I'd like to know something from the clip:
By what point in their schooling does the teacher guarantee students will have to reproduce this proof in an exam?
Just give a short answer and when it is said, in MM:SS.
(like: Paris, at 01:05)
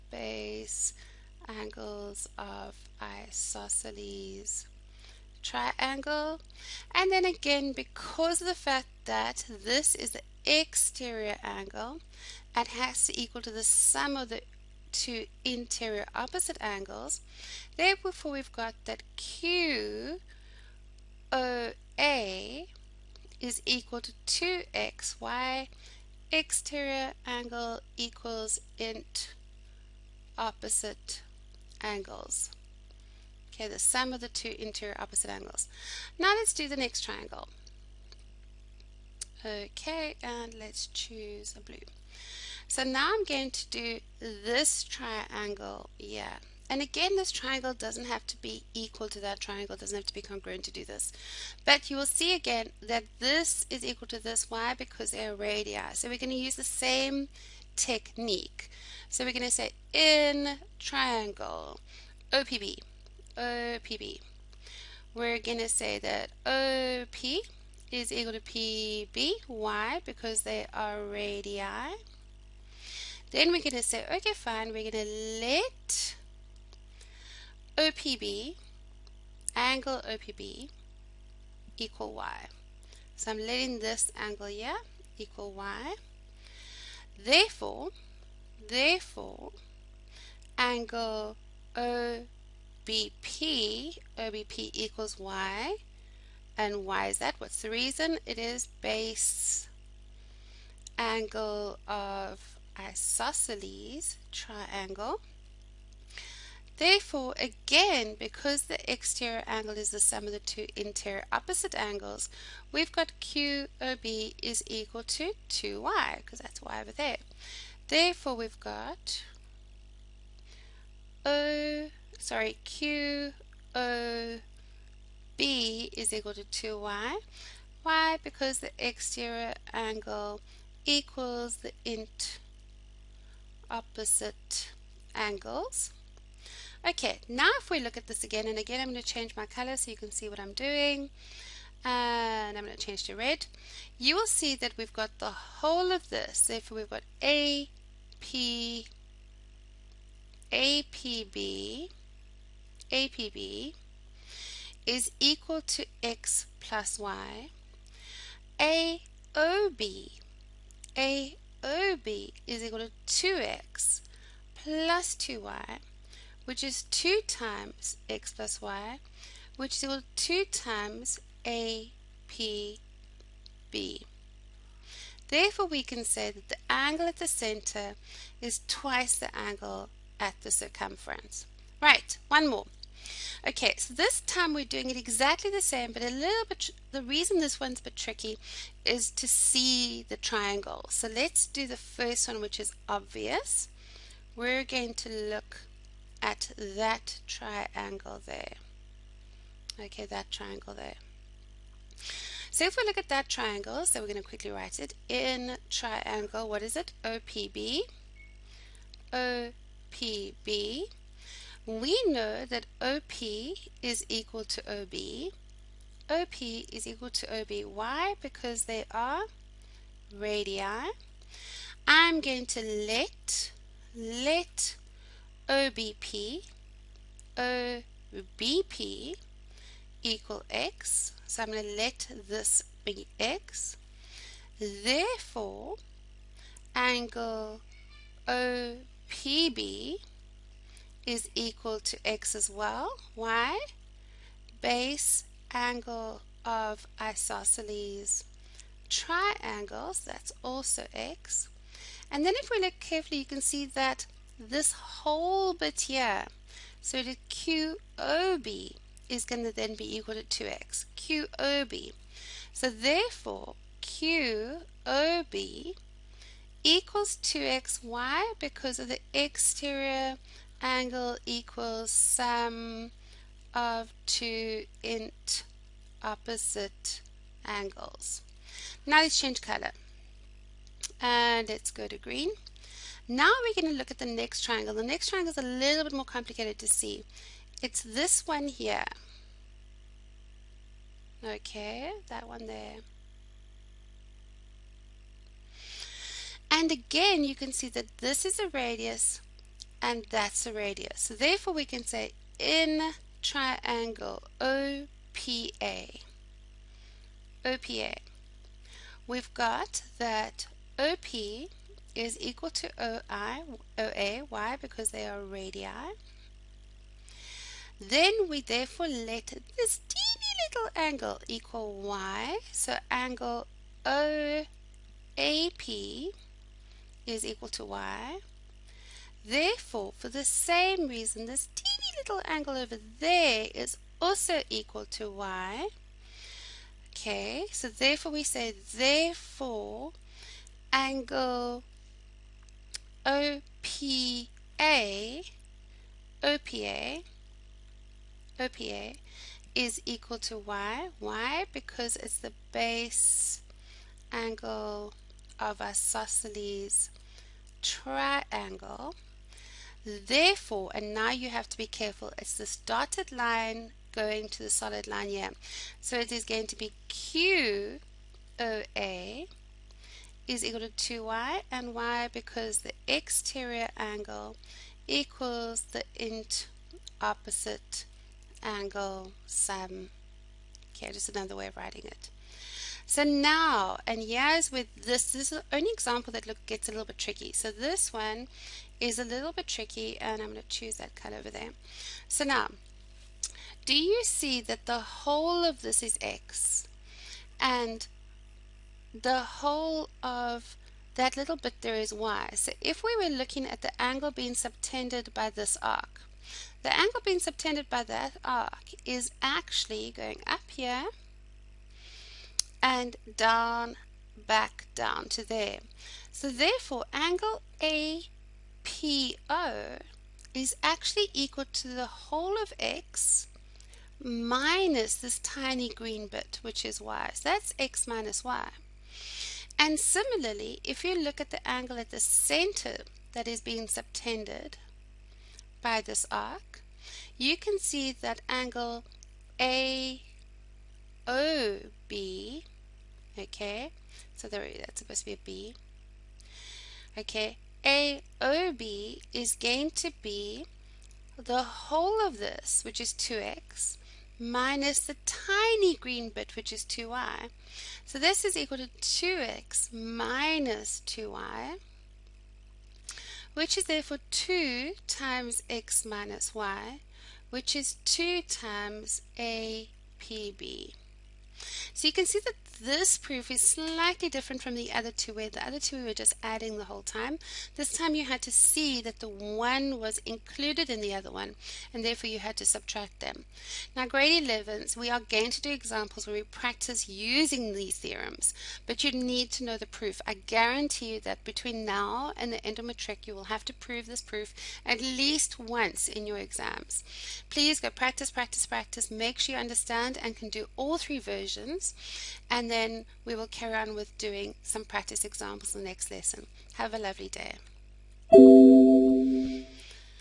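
End of matric, at 08:12.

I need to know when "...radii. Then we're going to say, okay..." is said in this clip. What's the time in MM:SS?
01:11.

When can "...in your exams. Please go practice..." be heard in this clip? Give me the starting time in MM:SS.
08:15.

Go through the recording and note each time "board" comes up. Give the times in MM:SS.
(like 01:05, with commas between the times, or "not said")
not said.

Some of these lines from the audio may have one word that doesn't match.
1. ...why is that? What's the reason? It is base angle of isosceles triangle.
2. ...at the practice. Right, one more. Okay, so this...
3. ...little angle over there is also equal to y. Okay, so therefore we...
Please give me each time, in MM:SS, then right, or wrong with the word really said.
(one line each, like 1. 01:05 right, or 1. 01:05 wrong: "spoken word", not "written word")
1. 01:36 right
2. 03:00 wrong: "circumference", not "practice"
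3. 05:31 right.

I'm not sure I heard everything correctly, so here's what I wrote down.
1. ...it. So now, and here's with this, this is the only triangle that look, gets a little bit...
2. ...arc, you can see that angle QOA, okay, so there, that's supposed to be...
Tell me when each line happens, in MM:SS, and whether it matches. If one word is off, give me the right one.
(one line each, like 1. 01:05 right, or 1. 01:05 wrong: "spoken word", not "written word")
1. 06:21 wrong: "example", not "triangle"
2. 07:16 wrong: "AOB", not "QOA".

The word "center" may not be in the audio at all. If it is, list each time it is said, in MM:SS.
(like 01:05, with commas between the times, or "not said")
02:57, 07:12.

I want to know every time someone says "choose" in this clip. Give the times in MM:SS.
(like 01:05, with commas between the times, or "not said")
00:40, 06:30.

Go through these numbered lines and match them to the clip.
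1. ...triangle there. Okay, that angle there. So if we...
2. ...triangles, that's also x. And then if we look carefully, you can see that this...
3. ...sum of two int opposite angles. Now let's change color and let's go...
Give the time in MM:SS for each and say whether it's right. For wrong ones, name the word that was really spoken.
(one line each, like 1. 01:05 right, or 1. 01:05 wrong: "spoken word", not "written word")
1. 03:17 wrong: "triangle", not "angle"
2. 04:08 right
3. 04:31 right.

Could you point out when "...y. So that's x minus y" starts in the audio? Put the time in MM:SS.
07:06.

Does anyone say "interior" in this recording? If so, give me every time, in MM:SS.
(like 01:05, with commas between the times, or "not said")
00:15, 00:34, 01:50.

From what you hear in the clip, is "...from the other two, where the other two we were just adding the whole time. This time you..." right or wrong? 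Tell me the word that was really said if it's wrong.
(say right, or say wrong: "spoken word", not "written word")
right.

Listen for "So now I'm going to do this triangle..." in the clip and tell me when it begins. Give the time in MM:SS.
00:42.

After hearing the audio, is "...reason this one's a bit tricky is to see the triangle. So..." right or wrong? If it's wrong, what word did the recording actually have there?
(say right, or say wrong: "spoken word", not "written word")
right.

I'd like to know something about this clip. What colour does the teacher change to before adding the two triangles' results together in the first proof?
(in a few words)
Red.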